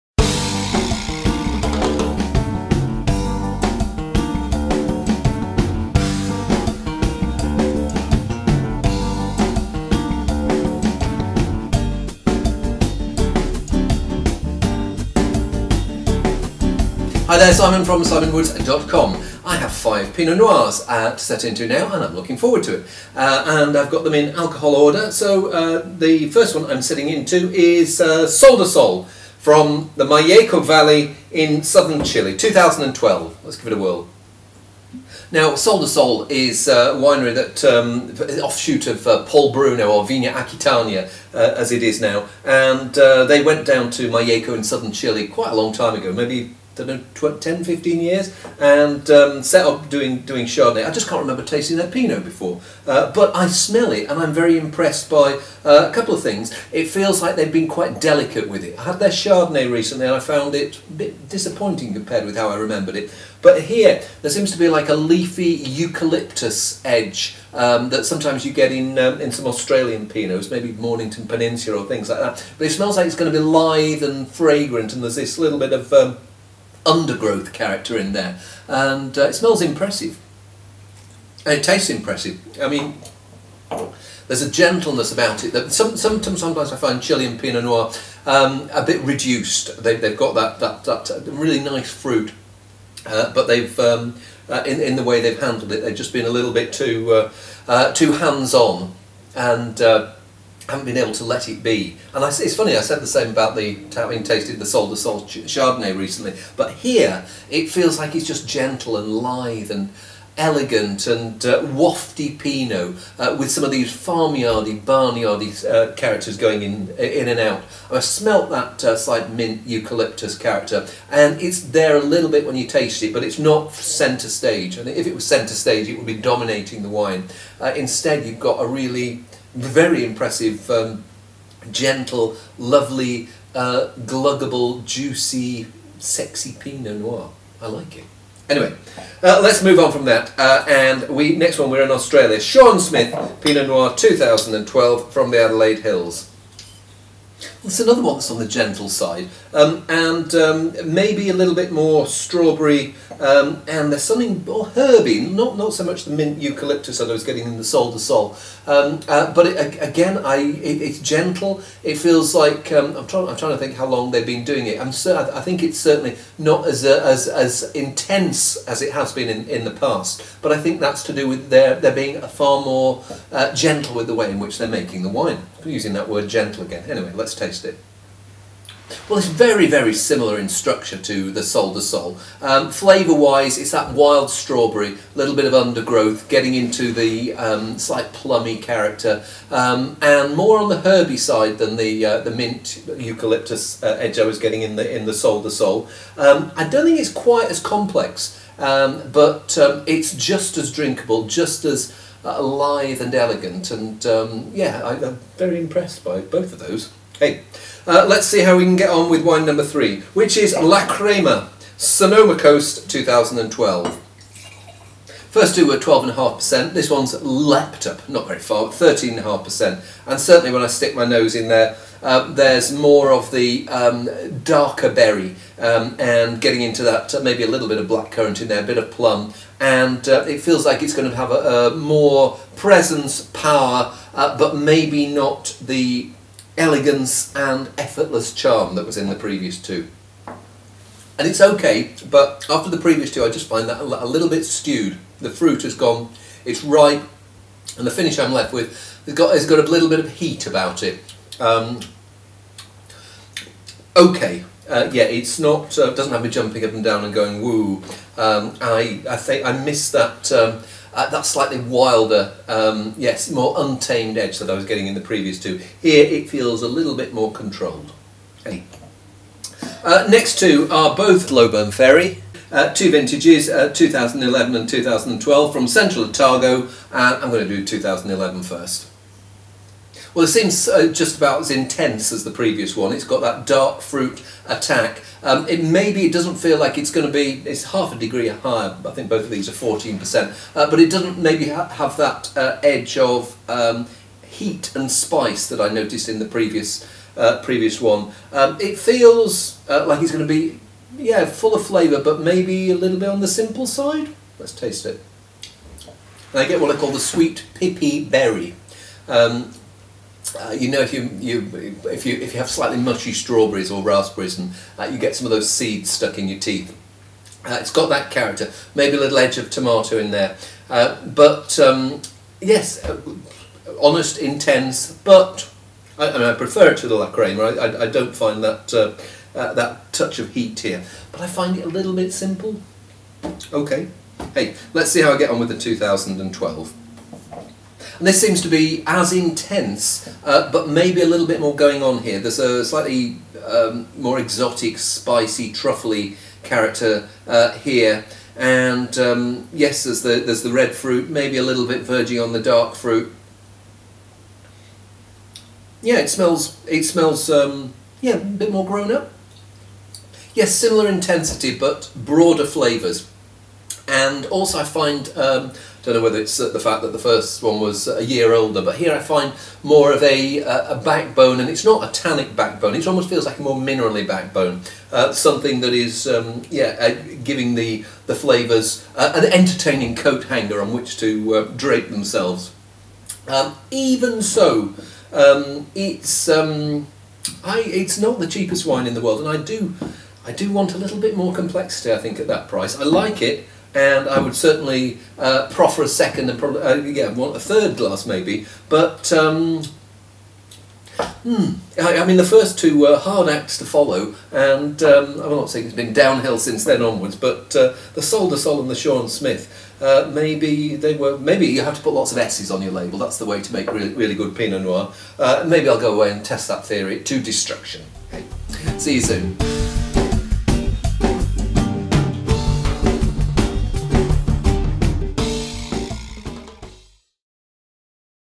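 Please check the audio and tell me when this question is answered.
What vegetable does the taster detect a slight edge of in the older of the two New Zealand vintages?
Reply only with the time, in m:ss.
5:19.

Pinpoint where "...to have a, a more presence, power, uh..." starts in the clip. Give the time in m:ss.
3:51.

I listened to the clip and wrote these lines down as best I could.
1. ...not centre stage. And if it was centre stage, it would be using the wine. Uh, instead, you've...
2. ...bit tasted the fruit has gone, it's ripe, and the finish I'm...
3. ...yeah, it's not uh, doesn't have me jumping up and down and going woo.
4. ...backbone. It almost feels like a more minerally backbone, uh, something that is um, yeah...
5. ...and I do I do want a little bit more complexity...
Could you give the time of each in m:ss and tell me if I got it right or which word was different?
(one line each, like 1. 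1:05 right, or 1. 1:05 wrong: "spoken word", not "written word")
1. 2:03 wrong: "dominating", not "using"
2. 4:04 wrong: "stewed", not "tasted"
3. 4:14 right
4. 6:12 right
5. 6:29 right.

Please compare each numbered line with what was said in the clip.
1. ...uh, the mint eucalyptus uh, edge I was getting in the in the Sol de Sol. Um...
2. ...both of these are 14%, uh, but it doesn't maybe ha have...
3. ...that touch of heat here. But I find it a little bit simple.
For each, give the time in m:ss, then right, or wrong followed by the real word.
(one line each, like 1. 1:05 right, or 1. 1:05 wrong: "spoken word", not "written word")
1. 3:12 right
2. 4:49 right
3. 5:29 right.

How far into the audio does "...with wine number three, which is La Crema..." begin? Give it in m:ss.
3:29.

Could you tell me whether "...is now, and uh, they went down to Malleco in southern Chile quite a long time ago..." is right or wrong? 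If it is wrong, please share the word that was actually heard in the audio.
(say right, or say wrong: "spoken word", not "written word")
right.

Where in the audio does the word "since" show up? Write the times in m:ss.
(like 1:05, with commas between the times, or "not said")
6:46.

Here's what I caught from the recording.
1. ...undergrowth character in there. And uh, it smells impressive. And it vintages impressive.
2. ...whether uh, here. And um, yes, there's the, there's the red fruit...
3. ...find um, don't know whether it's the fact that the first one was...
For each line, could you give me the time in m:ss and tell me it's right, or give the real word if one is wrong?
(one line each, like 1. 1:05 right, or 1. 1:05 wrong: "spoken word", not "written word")
1. 1:16 wrong: "tastes", not "vintages"
2. 5:46 wrong: "character", not "whether"
3. 6:04 right.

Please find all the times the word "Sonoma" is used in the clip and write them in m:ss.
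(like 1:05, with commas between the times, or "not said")
3:31.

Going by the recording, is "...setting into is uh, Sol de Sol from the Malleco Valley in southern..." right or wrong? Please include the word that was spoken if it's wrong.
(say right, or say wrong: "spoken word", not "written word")
right.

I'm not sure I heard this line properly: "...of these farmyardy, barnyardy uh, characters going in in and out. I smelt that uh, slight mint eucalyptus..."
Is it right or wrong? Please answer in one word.
right.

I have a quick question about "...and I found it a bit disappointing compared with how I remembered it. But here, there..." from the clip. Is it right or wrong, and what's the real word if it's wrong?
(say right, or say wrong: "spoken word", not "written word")
right.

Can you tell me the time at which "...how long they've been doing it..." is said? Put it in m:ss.
2:43.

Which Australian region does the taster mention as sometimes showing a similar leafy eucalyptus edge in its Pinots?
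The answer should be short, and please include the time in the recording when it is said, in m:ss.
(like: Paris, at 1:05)
Mornington Peninsula, at 1:10.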